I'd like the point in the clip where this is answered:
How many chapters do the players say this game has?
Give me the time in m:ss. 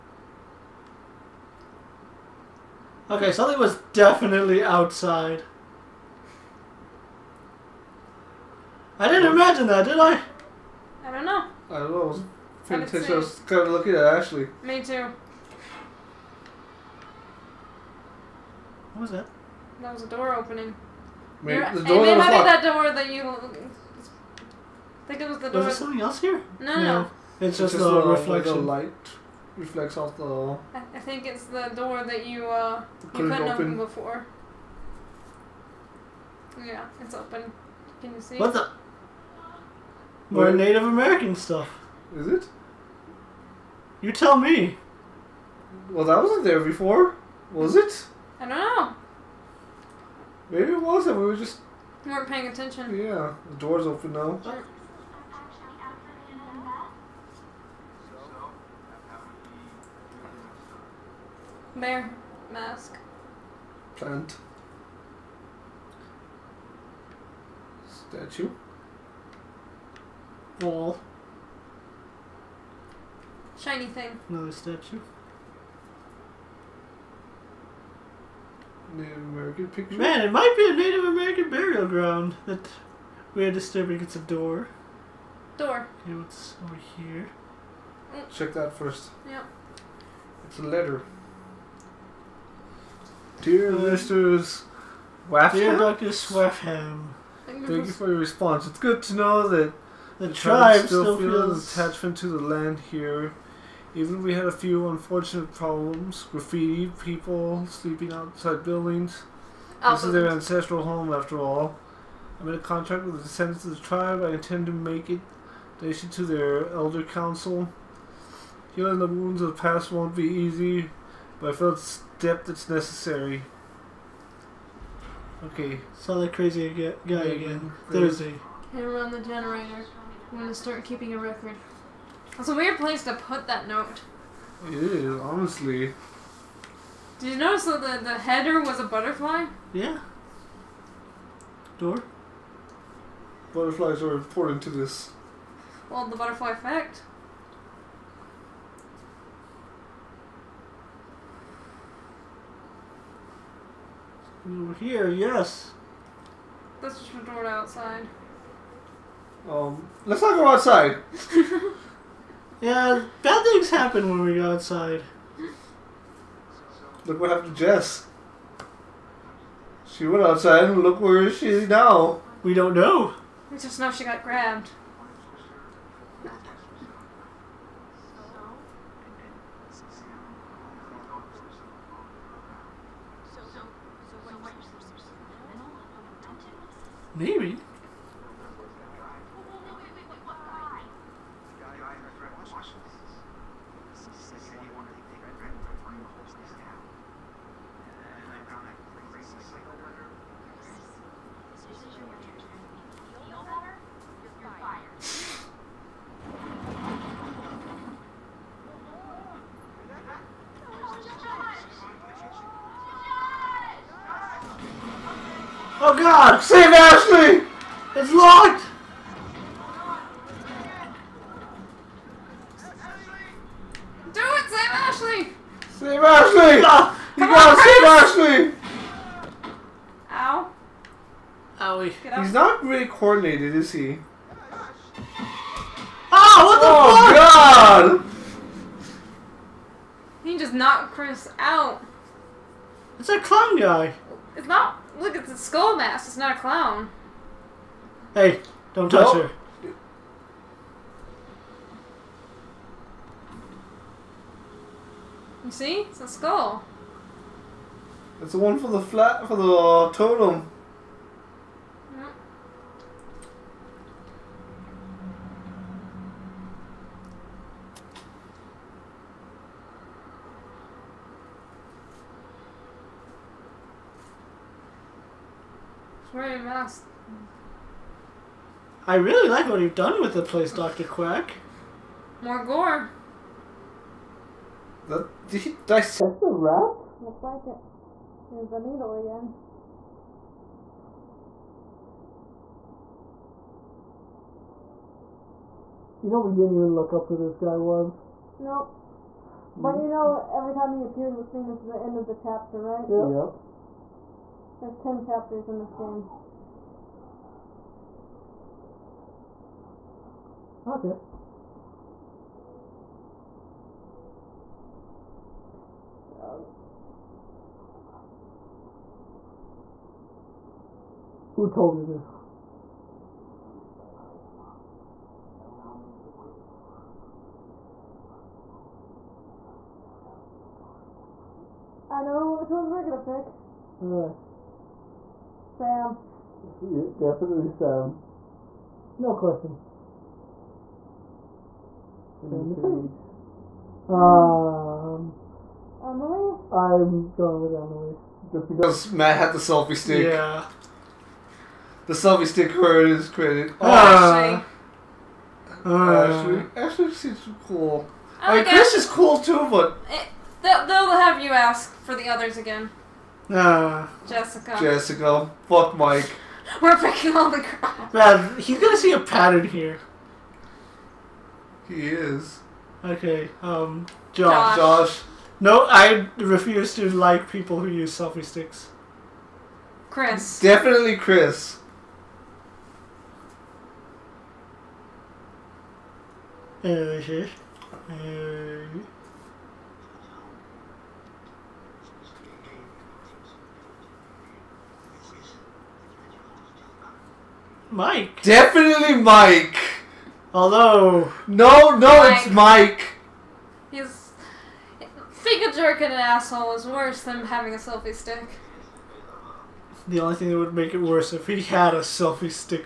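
5:04.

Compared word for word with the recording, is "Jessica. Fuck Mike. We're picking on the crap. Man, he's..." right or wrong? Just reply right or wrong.
right.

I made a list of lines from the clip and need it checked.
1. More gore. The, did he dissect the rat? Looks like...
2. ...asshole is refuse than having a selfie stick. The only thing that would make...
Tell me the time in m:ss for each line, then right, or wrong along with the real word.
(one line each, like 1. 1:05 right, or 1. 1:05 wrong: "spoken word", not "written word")
1. 4:42 right
2. 6:45 wrong: "worse", not "refuse".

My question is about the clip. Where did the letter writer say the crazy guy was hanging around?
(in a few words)
The generator.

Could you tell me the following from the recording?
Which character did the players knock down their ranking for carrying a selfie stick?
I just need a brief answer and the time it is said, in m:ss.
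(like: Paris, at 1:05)
Matt, at 5:48.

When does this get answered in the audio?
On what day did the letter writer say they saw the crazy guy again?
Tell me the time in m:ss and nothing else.
2:07.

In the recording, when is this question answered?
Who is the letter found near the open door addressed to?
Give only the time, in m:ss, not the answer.
1:35.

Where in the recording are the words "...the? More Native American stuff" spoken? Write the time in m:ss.
0:38.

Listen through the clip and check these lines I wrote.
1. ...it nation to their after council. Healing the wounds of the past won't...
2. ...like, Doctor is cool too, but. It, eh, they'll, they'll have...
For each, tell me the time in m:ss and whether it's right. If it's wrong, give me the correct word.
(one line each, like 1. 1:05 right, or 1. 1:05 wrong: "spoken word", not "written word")
1. 1:55 wrong: "elder", not "after"
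2. 5:58 wrong: "Chris", not "Doctor".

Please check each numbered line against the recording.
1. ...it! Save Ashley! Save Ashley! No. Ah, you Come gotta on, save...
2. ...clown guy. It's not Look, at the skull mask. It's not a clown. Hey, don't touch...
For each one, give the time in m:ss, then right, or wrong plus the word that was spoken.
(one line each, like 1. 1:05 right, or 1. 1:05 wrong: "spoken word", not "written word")
1. 3:44 right
2. 4:03 right.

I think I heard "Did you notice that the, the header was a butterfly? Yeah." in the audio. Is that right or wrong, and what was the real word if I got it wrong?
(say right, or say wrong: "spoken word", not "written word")
right.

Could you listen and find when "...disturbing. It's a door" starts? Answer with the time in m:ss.
1:23.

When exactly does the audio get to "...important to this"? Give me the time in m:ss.
2:24.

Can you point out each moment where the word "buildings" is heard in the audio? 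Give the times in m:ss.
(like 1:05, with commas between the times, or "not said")
1:48.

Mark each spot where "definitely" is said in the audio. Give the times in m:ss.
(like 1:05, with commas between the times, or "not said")
0:03, 5:36, 6:20, 6:38.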